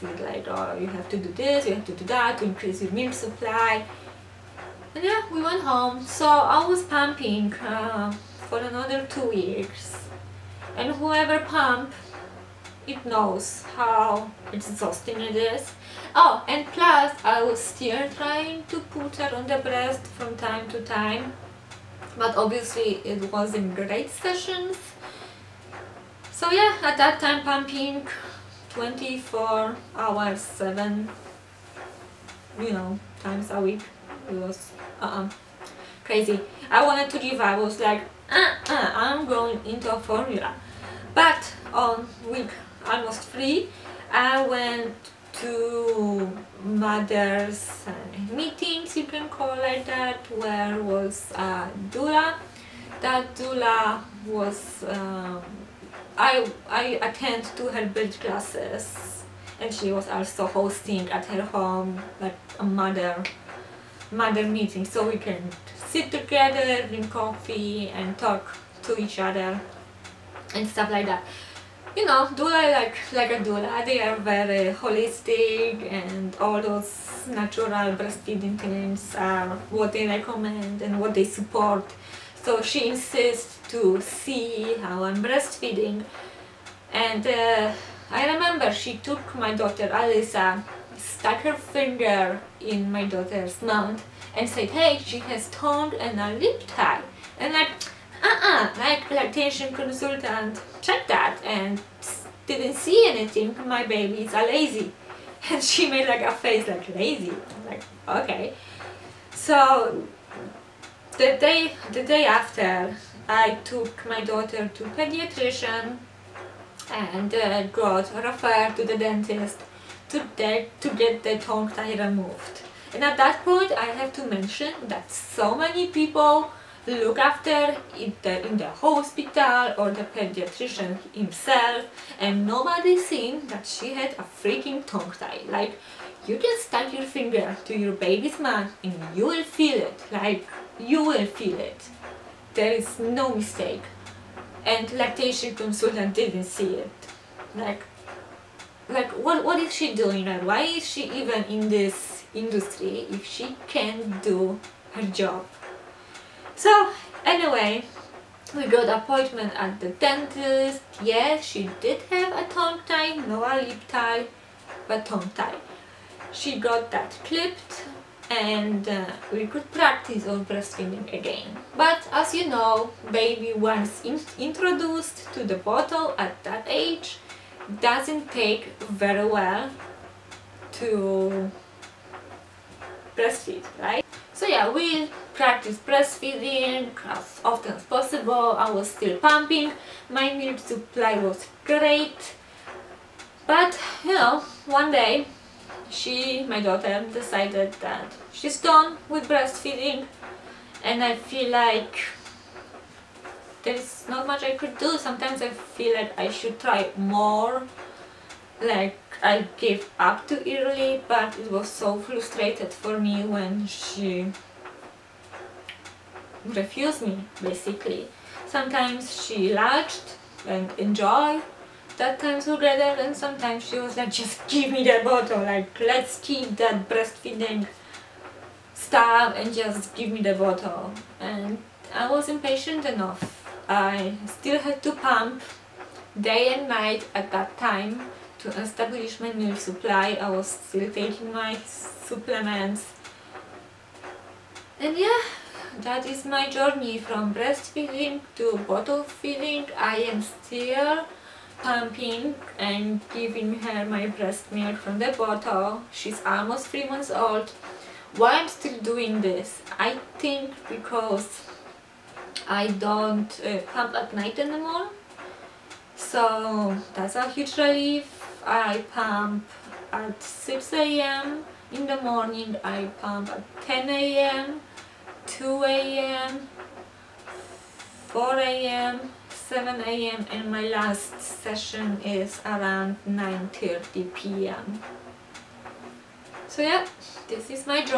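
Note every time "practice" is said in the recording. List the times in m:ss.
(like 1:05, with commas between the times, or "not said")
2:49, 3:05.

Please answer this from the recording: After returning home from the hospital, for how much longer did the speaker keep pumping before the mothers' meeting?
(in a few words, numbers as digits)
2 weeks.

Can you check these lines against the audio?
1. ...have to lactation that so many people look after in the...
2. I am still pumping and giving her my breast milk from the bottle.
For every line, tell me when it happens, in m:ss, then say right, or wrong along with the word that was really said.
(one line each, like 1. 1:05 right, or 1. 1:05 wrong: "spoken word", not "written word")
1. 2:03 wrong: "mention", not "lactation"
2. 4:09 right.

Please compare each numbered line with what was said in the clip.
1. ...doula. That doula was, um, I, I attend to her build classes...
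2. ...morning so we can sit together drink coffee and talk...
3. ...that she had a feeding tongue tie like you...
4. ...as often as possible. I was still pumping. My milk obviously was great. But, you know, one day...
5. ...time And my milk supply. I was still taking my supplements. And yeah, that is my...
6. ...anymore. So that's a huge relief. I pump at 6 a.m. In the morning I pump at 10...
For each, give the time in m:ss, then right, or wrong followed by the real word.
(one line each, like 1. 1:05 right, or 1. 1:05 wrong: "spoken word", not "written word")
1. 0:51 right
2. 1:04 wrong: "meeting", not "morning"
3. 2:13 wrong: "freaking", not "feeding"
4. 3:07 wrong: "supply", not "obviously"
5. 3:57 wrong: "Establish", not "And"
6. 4:24 right.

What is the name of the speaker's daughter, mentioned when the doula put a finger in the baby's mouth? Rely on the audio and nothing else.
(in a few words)
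Alyssa.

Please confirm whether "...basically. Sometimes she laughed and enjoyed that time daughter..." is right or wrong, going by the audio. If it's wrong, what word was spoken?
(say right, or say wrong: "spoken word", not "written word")
wrong: "together", not "daughter".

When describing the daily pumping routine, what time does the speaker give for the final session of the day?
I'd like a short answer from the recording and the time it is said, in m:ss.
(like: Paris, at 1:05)
9:30 p.m., at 4:43.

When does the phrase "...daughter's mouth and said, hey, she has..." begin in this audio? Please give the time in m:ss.
1:33.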